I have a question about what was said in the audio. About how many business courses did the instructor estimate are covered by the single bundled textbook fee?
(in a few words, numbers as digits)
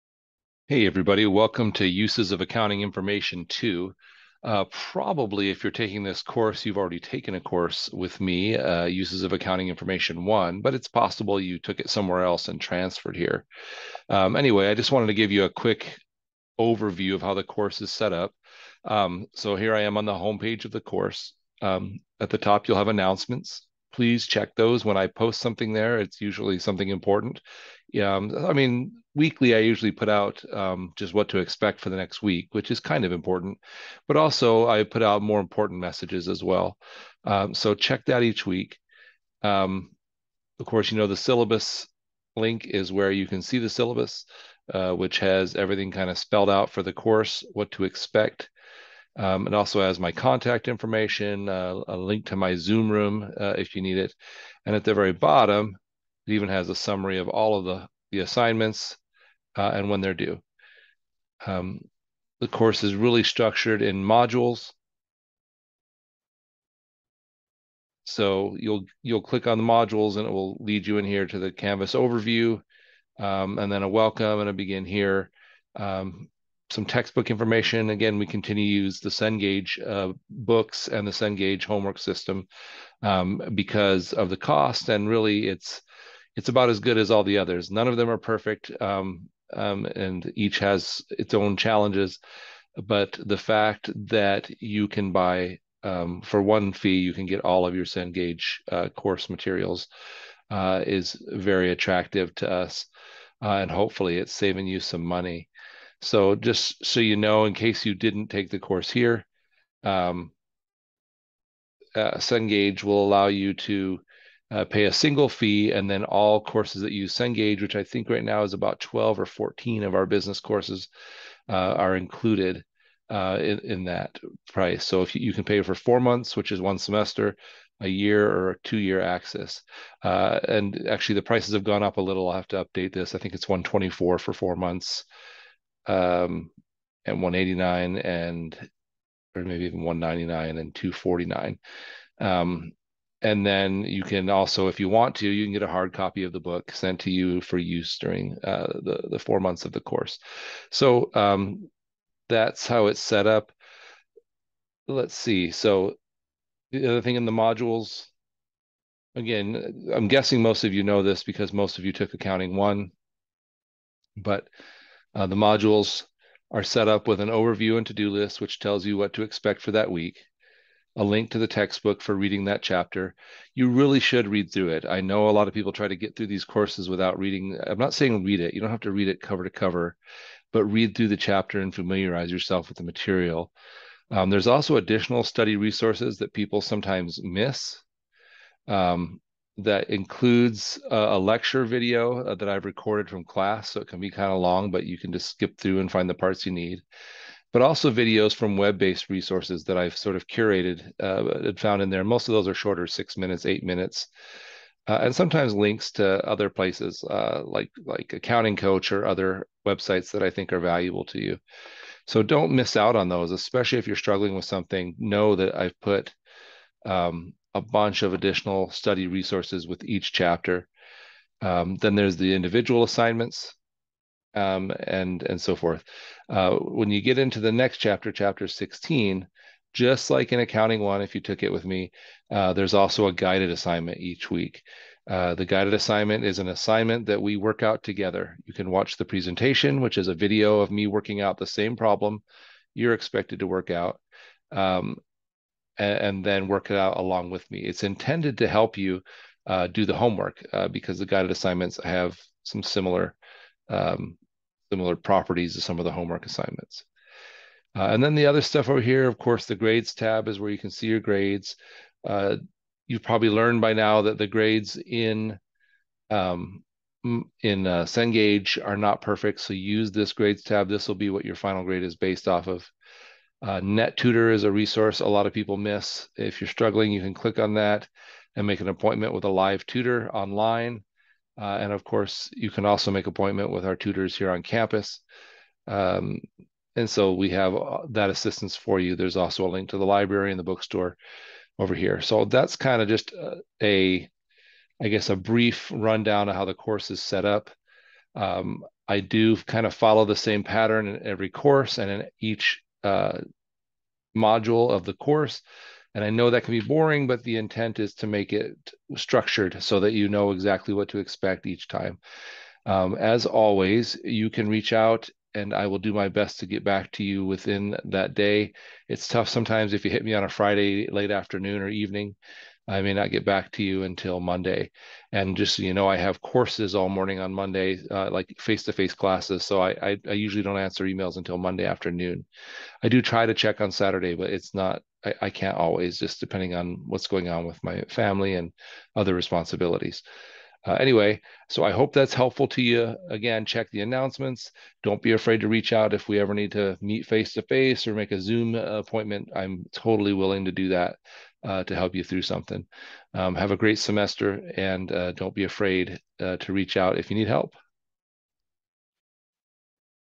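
12 or 14.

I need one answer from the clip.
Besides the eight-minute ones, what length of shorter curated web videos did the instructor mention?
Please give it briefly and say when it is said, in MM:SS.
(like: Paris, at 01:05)
6 minutes, at 03:22.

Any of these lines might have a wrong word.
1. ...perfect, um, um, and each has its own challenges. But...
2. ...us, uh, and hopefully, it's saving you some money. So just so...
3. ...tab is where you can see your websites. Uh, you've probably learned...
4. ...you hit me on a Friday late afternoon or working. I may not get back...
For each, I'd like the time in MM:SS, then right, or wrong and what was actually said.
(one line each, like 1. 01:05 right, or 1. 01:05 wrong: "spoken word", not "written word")
1. 01:28 right
2. 01:42 right
3. 04:19 wrong: "grades", not "websites"
4. 05:19 wrong: "evening", not "working".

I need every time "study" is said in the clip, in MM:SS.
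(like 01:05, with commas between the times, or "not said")
03:05, 03:38.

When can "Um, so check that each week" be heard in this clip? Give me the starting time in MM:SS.
00:37.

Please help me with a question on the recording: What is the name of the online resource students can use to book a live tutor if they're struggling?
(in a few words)
NetTutor.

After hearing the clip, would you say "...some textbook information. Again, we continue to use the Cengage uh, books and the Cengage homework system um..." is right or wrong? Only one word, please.
right.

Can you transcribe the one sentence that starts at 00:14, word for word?
Um, anyway, I just wanted to give you a quick overview of how the course is set up.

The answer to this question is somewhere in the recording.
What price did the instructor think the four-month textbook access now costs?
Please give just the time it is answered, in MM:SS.
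02:13.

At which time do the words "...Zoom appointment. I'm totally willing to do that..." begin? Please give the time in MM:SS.
05:48.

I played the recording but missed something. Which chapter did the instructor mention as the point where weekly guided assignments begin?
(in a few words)
chapter 16.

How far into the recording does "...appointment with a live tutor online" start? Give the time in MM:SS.
04:38.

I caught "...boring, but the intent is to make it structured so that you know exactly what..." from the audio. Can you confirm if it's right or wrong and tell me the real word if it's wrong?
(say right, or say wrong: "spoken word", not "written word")
right.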